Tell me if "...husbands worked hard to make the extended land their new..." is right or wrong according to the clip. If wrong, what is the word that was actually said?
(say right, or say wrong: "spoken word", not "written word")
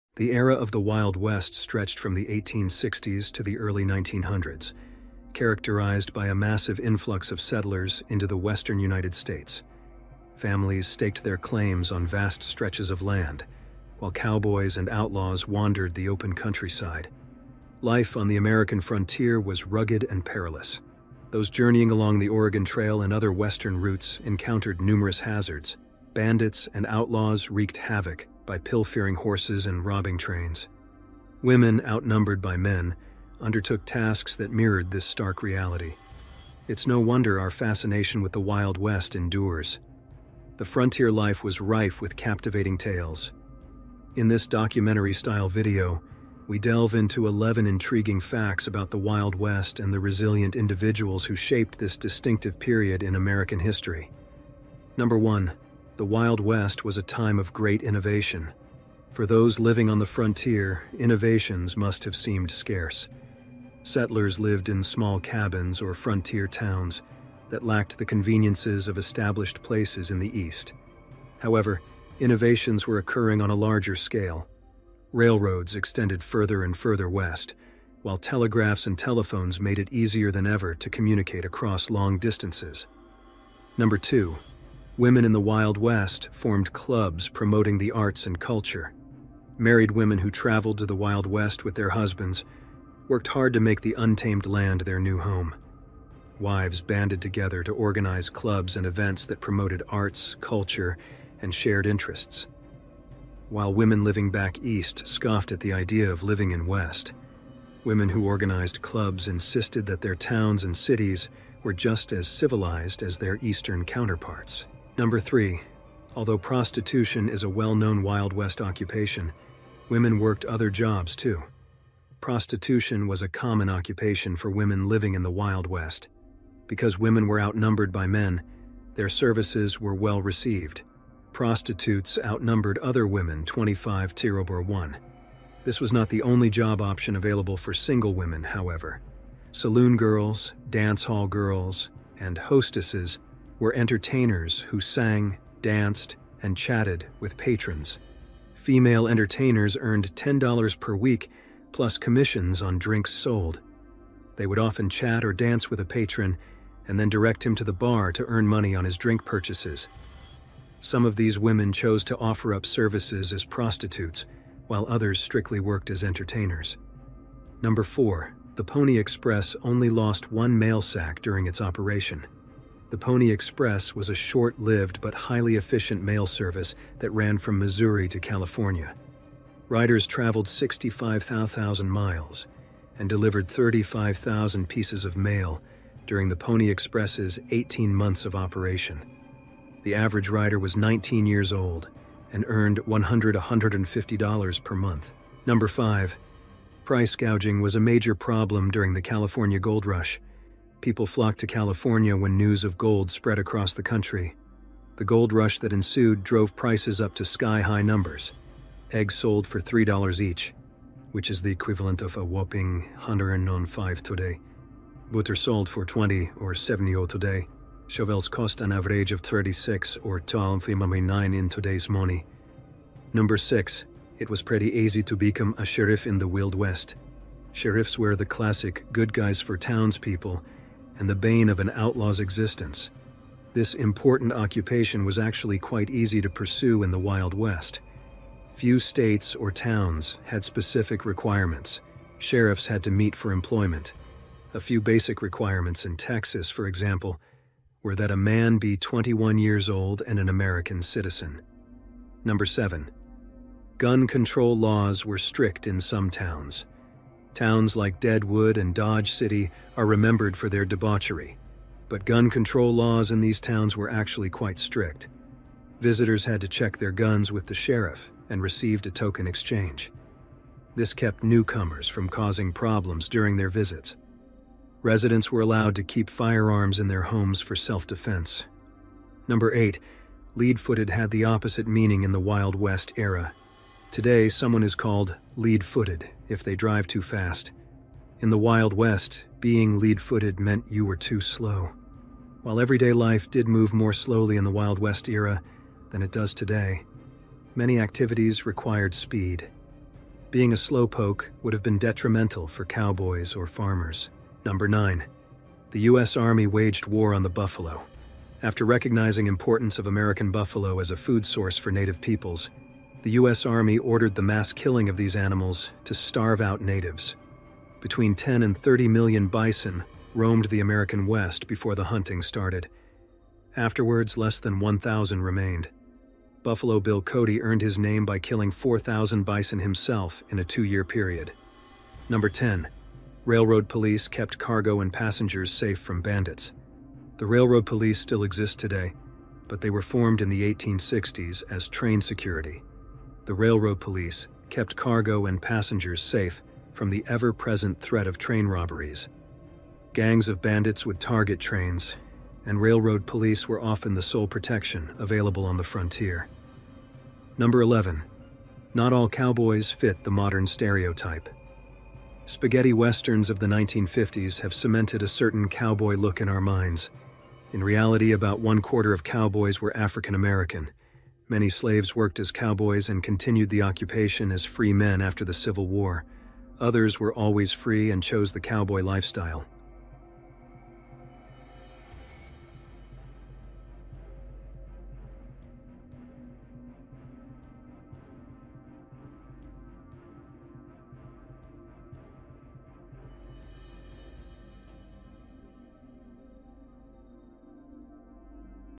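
wrong: "untamed", not "extended".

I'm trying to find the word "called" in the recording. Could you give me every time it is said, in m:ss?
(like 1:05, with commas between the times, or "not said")
4:44.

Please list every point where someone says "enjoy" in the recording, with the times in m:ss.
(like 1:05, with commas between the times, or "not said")
not said.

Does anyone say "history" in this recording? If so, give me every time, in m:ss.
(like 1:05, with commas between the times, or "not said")
0:53.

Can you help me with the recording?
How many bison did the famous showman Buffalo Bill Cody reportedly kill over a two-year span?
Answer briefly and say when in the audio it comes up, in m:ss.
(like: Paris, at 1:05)
4,000, at 5:28.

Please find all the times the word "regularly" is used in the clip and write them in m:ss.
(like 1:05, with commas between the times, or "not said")
not said.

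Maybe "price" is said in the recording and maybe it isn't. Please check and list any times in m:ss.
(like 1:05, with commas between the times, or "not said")
3:16, 3:26.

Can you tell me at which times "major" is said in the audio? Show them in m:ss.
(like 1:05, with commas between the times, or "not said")
3:17.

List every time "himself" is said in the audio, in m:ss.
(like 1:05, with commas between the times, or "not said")
5:29.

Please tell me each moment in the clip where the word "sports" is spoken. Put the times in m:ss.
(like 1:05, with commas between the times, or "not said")
not said.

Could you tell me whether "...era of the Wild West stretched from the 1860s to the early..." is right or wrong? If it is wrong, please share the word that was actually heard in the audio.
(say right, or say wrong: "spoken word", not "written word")
right.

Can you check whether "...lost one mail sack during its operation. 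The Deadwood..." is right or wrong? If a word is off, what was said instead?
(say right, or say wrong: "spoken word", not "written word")
wrong: "Pony", not "Deadwood".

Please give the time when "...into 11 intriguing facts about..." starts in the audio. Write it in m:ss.
0:46.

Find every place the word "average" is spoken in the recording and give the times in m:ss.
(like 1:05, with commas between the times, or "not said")
3:09, 3:38.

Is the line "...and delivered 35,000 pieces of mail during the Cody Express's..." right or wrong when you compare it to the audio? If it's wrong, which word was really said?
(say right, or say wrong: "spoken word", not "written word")
wrong: "Pony", not "Cody".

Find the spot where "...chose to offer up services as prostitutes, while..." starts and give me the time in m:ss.
2:41.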